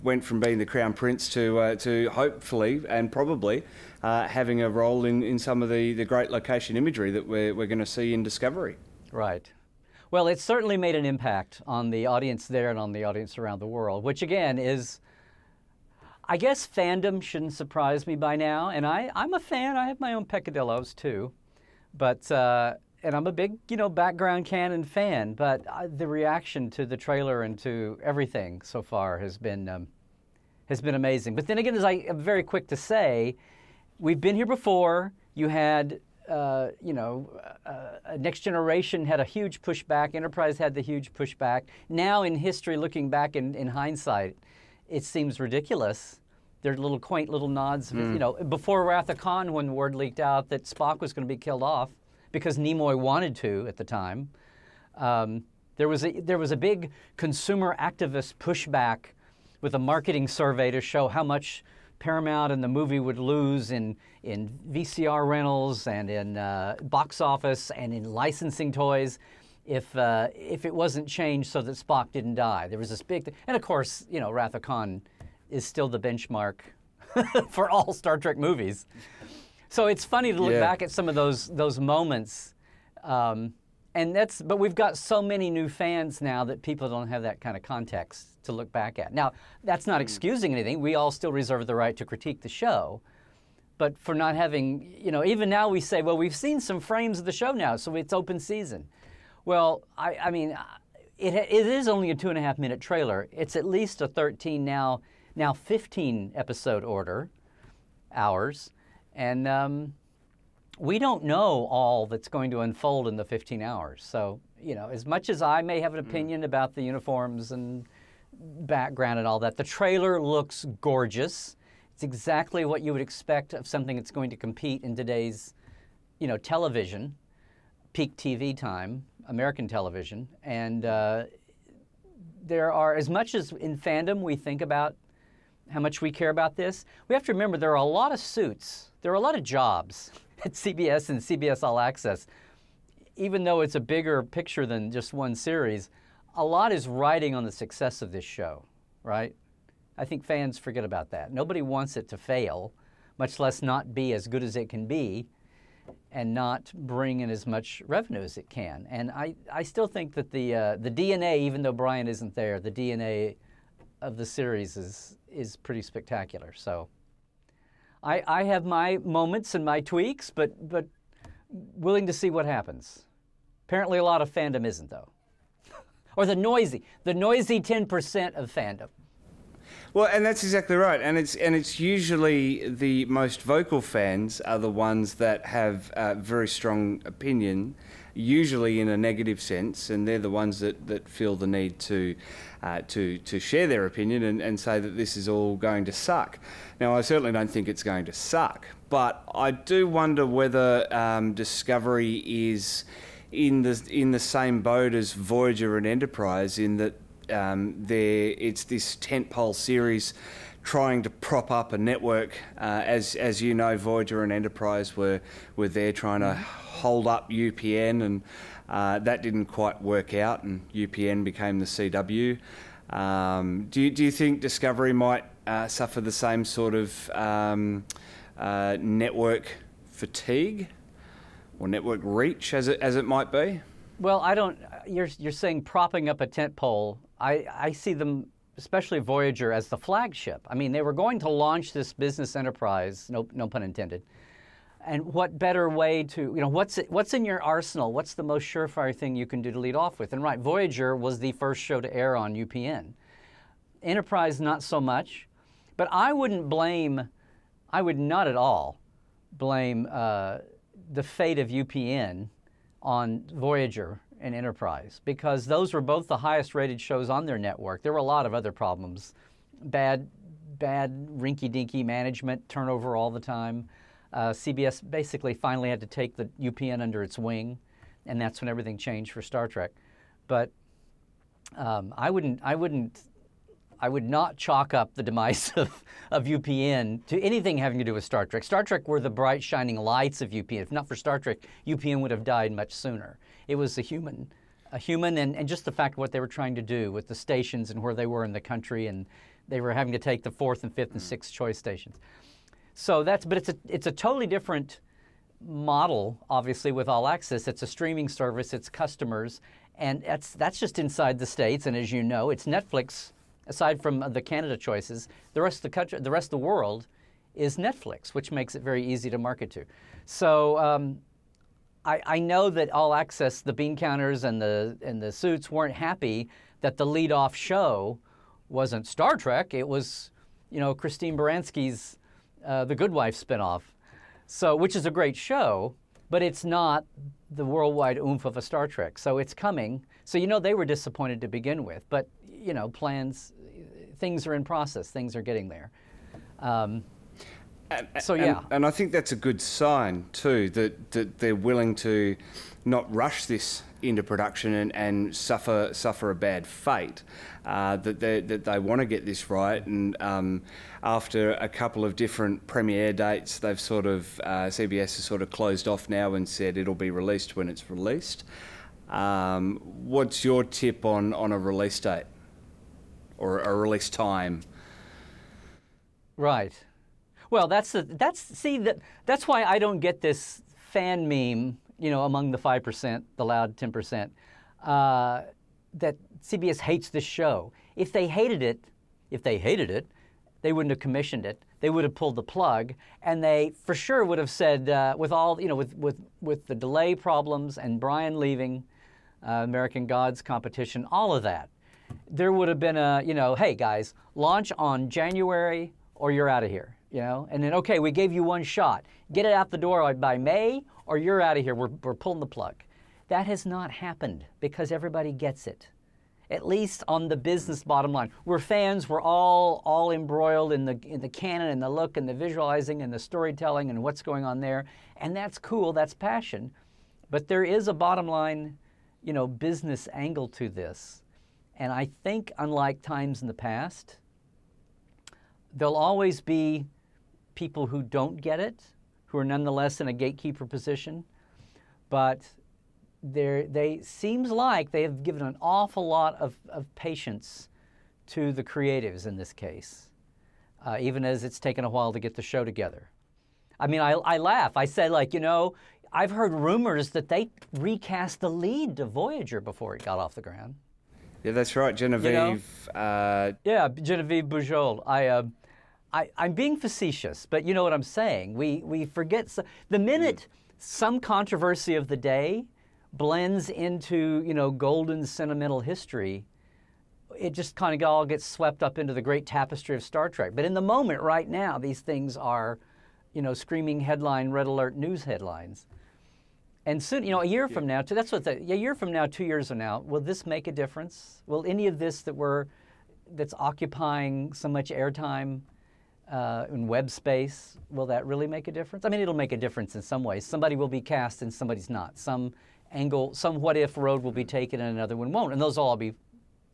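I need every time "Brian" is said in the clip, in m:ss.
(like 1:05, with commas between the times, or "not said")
2:41, 6:37.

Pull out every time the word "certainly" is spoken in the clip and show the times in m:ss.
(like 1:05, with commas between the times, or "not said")
0:10, 3:17.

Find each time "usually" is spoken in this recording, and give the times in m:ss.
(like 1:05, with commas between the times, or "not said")
3:01, 3:08.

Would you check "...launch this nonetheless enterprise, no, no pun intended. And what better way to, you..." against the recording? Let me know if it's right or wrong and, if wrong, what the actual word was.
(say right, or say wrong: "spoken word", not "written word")
wrong: "business", not "nonetheless".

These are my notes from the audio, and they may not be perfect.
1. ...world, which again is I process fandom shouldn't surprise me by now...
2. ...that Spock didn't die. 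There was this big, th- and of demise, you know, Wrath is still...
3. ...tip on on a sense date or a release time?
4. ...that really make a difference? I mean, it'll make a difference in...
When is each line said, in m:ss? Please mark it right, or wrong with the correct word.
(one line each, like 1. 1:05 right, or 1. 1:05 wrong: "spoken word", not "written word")
1. 0:13 wrong: "guess", not "process"
2. 1:11 wrong: "course", not "demise"
3. 6:10 wrong: "release", not "sense"
4. 8:17 right.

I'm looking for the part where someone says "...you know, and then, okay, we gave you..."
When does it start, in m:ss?
6:46.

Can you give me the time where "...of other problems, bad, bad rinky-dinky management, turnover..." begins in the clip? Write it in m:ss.
4:28.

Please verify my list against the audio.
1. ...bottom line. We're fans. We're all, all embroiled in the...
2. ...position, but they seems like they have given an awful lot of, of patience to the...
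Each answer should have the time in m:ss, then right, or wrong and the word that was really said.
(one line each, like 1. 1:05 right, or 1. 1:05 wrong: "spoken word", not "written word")
1. 6:57 right
2. 7:20 right.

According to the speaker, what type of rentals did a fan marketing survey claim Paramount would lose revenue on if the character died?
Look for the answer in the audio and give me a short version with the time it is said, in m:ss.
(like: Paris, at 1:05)
VCR rentals, at 1:04.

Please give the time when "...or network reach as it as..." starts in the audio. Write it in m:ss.
3:51.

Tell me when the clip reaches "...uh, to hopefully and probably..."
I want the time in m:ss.
0:01.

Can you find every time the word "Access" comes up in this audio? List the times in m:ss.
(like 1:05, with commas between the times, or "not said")
2:21, 5:07, 5:22.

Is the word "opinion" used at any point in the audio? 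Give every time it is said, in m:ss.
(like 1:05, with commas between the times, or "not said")
1:56, 3:07, 3:13.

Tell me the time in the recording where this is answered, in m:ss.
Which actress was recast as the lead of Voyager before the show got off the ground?
7:43.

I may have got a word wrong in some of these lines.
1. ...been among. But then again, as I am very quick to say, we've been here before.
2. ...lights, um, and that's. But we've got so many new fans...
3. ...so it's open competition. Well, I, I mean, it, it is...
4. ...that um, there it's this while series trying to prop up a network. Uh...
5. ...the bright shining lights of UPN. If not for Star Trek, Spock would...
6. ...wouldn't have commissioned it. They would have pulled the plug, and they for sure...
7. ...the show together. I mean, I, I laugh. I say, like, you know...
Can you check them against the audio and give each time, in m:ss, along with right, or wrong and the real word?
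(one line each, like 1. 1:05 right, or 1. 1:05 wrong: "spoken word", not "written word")
1. 0:30 wrong: "amazing", not "among"
2. 1:21 wrong: "moments", not "lights"
3. 1:37 wrong: "season", not "competition"
4. 3:26 wrong: "tentpole", not "while"
5. 4:48 wrong: "UPN", not "Spock"
6. 6:30 right
7. 7:32 right.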